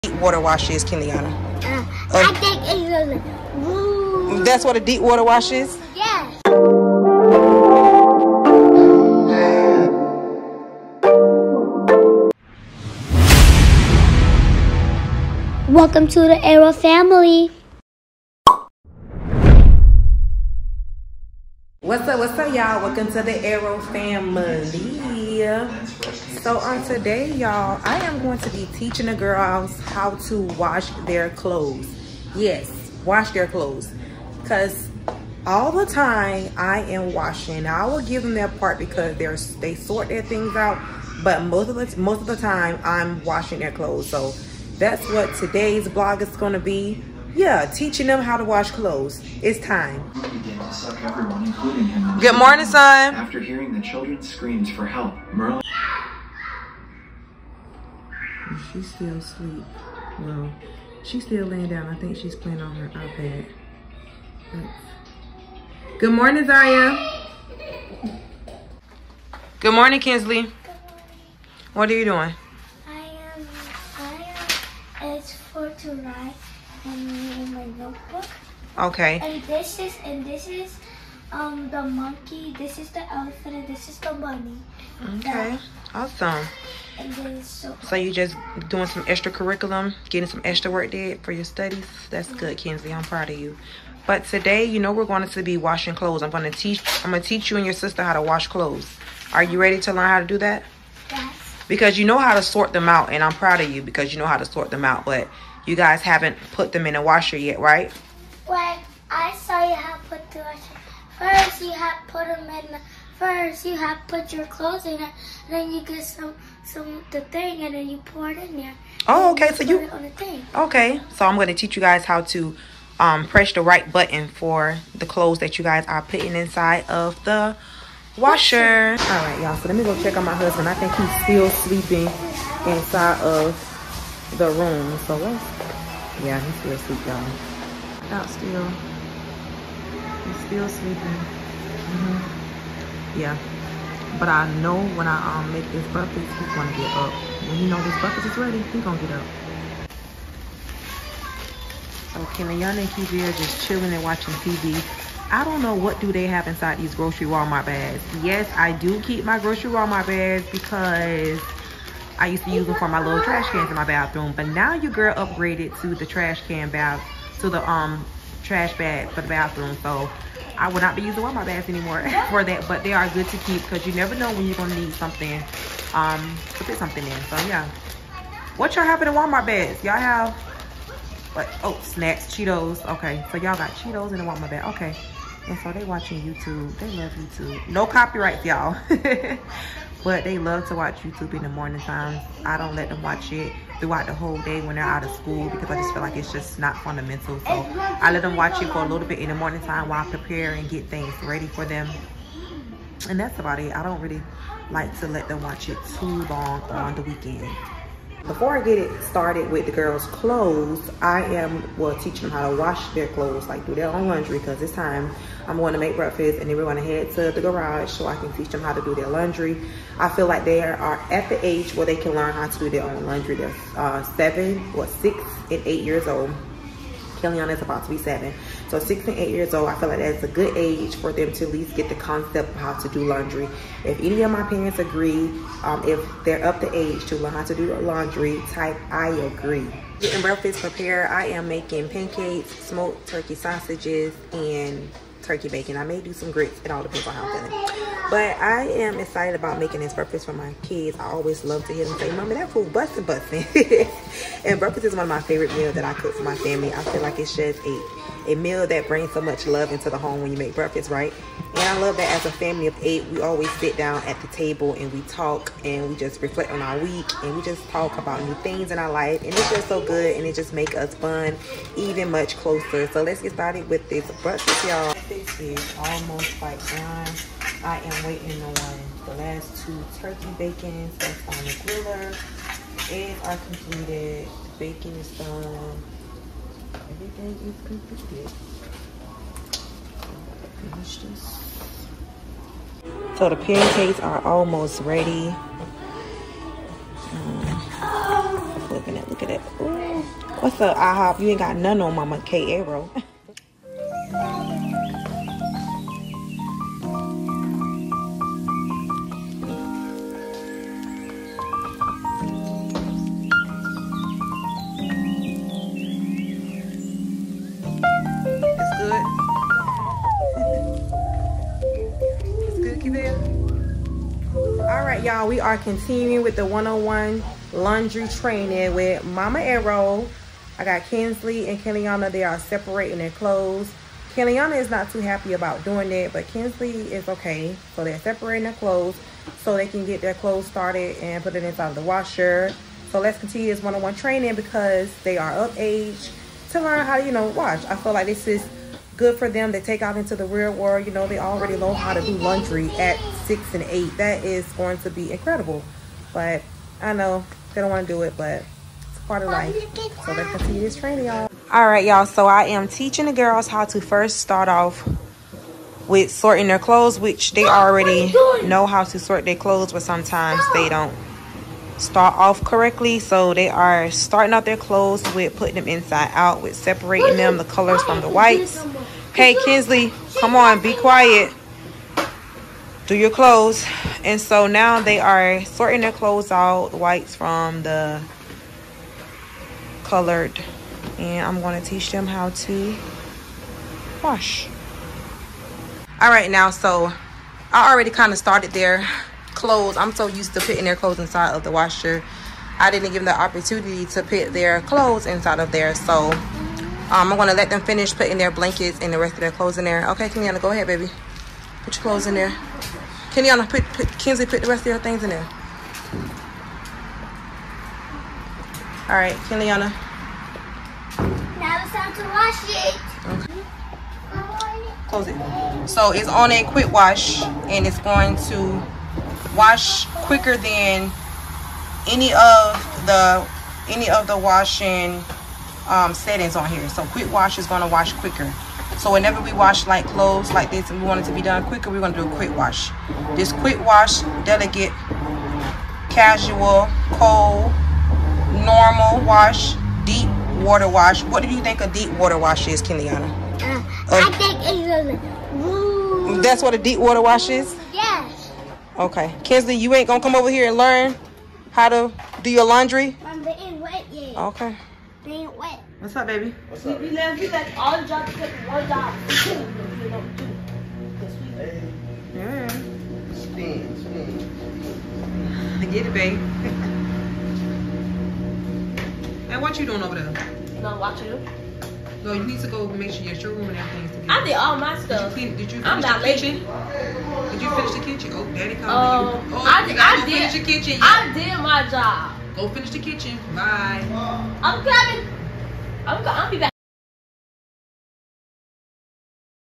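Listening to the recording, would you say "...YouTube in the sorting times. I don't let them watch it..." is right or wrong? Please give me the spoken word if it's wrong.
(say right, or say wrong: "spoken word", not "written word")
wrong: "morning", not "sorting".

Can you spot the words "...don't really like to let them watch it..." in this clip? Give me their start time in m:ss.
3:23.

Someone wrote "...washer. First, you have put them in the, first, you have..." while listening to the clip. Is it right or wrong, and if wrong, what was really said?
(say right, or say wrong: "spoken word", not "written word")
right.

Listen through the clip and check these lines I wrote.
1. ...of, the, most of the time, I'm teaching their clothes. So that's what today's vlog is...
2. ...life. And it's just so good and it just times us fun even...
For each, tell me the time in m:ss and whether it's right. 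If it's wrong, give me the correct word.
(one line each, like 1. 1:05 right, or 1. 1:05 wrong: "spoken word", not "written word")
1. 0:41 wrong: "washing", not "teaching"
2. 4:28 wrong: "makes", not "times".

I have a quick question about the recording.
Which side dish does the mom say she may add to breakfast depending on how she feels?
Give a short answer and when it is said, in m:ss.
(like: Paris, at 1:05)
grits, at 4:06.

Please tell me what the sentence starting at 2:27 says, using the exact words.
When he know this breakfast is ready, he's gonna get up.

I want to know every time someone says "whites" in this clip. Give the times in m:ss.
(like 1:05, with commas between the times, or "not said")
6:18, 6:26.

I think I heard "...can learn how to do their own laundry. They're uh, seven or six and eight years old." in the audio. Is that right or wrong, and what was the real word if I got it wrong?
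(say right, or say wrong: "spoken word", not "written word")
right.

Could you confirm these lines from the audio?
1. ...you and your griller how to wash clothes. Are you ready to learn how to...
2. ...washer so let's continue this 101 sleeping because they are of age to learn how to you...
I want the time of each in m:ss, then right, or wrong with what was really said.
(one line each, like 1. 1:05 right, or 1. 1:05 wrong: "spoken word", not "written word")
1. 1:37 wrong: "sister", not "griller"
2. 5:41 wrong: "training", not "sleeping".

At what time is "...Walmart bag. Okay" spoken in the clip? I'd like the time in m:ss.
3:04.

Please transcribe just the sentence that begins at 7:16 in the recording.
So quick wash is going to wash quicker.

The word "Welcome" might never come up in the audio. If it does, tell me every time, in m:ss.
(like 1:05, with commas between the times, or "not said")
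0:15, 0:22.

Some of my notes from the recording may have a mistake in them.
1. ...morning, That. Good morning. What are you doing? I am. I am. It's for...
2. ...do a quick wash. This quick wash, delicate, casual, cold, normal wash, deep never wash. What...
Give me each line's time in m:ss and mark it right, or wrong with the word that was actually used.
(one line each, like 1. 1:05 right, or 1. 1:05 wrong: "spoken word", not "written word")
1. 1:09 wrong: "Kinsley", not "That"
2. 7:22 wrong: "water", not "never".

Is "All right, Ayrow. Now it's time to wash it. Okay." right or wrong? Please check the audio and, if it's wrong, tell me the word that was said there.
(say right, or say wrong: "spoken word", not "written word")
wrong: "Kenyatta", not "Ayrow".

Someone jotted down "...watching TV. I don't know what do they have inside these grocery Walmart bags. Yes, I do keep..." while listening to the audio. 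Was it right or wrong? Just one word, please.
right.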